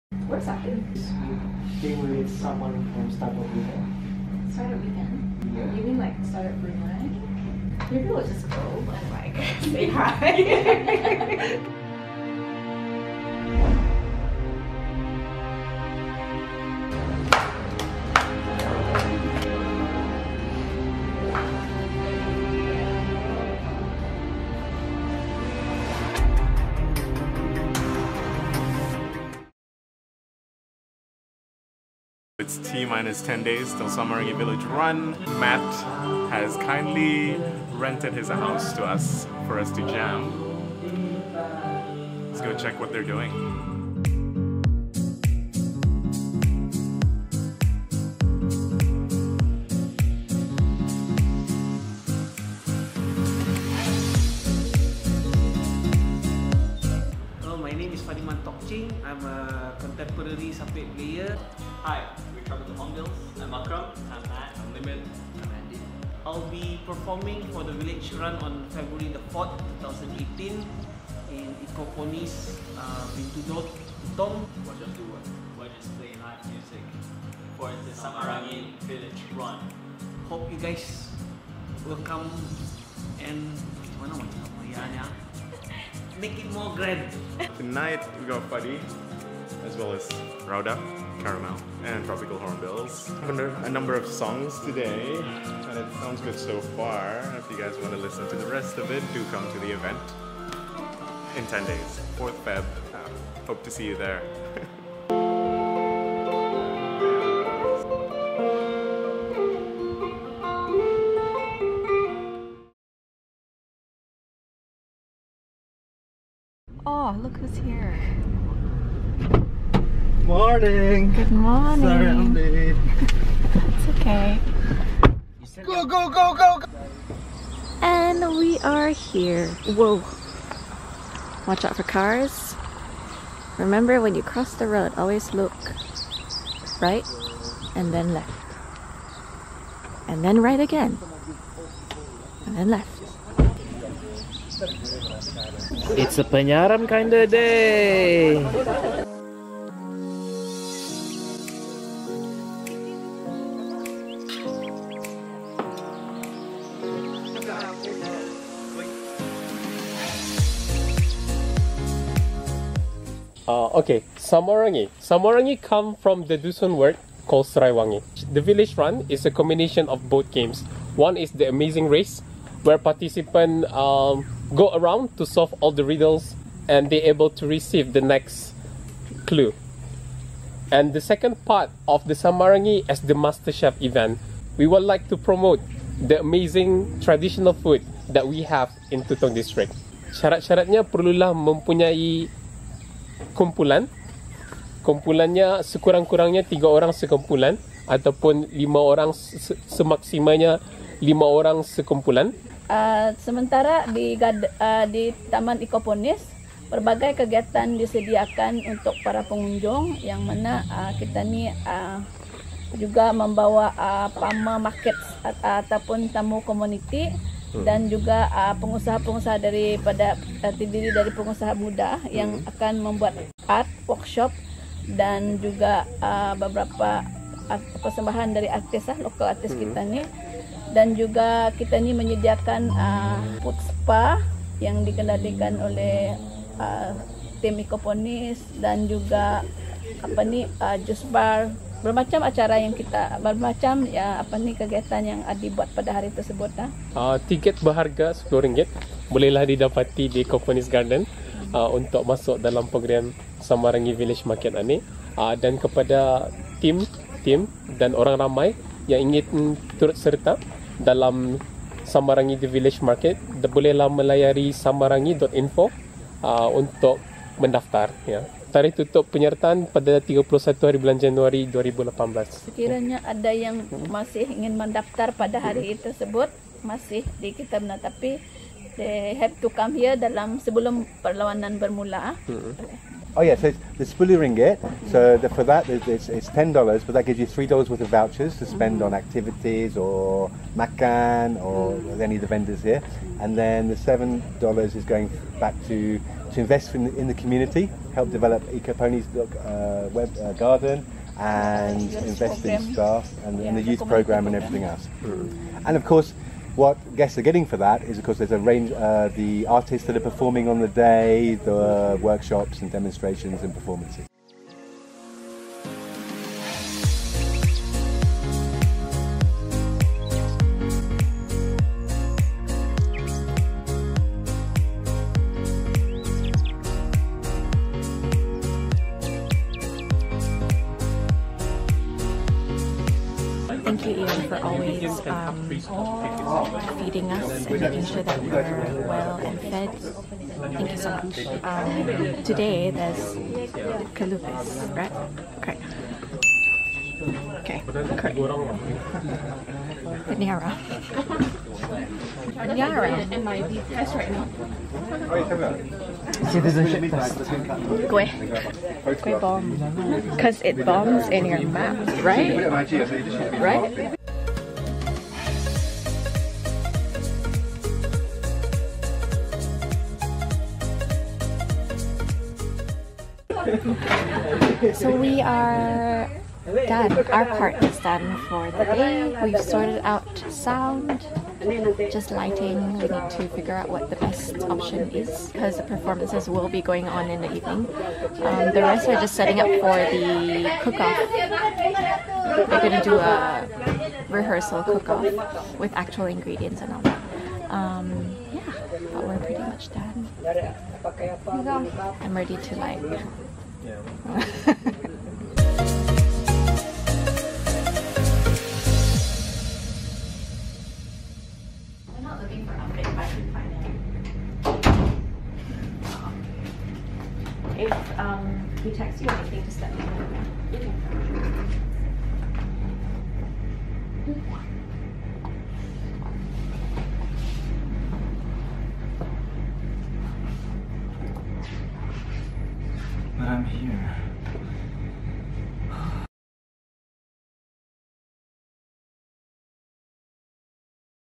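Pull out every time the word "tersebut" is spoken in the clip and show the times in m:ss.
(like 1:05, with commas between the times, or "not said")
4:06, 4:35.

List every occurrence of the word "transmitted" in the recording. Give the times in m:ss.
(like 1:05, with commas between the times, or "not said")
not said.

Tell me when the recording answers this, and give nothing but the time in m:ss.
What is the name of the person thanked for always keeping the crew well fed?
5:34.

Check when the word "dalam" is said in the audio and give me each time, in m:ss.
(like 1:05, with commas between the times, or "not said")
4:12, 4:20, 4:39.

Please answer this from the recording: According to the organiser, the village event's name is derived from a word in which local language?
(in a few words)
Dusun.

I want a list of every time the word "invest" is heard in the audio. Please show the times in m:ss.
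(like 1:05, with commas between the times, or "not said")
4:56, 5:01.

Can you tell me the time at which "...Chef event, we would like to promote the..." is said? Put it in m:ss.
3:03.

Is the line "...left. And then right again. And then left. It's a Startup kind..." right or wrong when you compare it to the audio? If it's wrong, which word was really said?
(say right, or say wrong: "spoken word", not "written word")
wrong: "Panyaram", not "Startup".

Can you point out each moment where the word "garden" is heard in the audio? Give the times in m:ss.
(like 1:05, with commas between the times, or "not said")
4:10, 5:00.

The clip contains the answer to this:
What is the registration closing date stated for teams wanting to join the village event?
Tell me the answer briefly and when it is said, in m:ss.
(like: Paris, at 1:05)
31 January 2018, at 4:30.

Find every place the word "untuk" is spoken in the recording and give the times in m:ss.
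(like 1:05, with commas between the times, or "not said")
3:28, 4:11, 4:26.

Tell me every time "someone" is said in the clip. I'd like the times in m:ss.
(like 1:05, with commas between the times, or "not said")
0:02.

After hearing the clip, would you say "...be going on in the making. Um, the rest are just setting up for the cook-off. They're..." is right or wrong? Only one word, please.
wrong.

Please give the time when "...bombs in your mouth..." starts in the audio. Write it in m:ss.
6:00.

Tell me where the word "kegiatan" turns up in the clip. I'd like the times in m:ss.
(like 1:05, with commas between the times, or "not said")
3:27, 4:04.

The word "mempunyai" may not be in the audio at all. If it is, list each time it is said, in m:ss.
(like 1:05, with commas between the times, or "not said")
3:11.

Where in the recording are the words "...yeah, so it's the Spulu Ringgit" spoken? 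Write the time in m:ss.
4:43.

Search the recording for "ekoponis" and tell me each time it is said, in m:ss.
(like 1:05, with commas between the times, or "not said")
3:25, 3:57.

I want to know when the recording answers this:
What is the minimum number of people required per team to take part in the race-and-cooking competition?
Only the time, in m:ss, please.
3:16.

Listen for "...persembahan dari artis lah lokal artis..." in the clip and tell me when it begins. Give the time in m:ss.
3:47.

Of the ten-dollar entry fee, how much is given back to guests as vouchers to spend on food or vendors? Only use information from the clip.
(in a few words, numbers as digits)
3 dollars.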